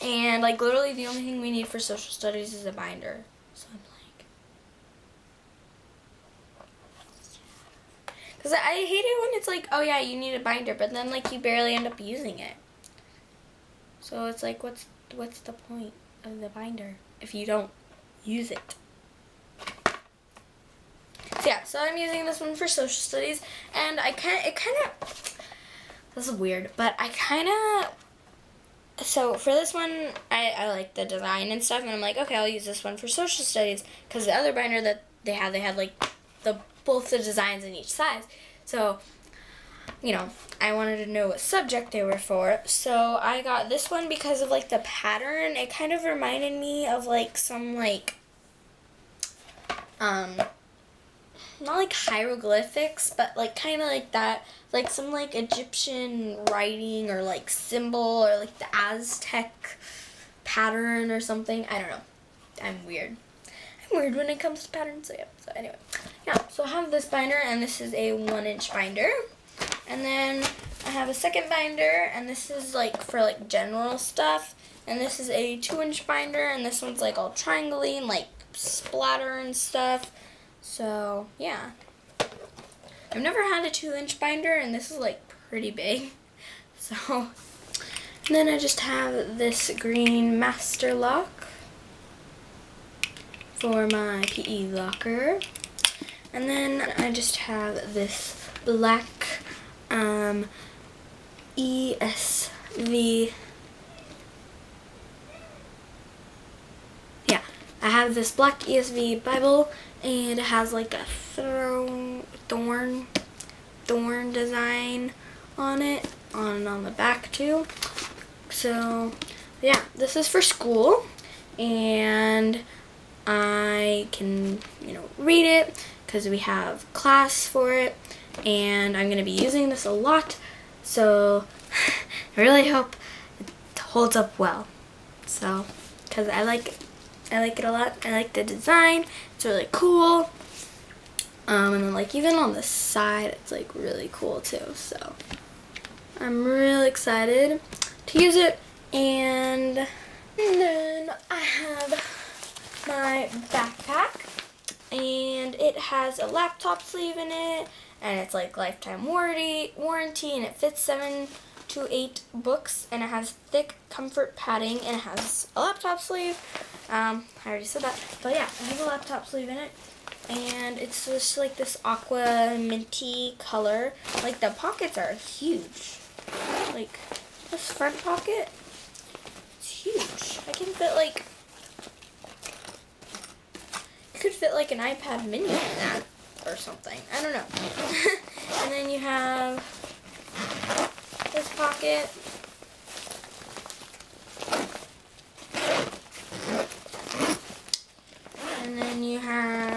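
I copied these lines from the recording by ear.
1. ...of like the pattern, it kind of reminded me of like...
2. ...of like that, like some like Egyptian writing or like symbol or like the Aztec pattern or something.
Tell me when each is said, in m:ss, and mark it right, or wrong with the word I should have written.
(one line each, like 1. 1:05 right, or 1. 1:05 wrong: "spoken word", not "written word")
1. 0:44 right
2. 0:53 right.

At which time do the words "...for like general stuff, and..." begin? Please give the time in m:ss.
1:13.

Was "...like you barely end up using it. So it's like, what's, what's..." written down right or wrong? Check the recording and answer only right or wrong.
right.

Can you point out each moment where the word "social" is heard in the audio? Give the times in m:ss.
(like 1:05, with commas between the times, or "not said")
0:01, 0:22, 0:33.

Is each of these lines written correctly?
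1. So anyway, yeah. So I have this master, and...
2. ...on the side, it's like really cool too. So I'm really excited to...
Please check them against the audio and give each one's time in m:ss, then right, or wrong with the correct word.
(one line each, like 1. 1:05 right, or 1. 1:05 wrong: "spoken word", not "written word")
1. 1:05 wrong: "binder", not "master"
2. 2:22 right.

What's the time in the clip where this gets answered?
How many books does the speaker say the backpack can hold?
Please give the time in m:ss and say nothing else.
2:40.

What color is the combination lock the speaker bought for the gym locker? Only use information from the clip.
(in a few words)
Green.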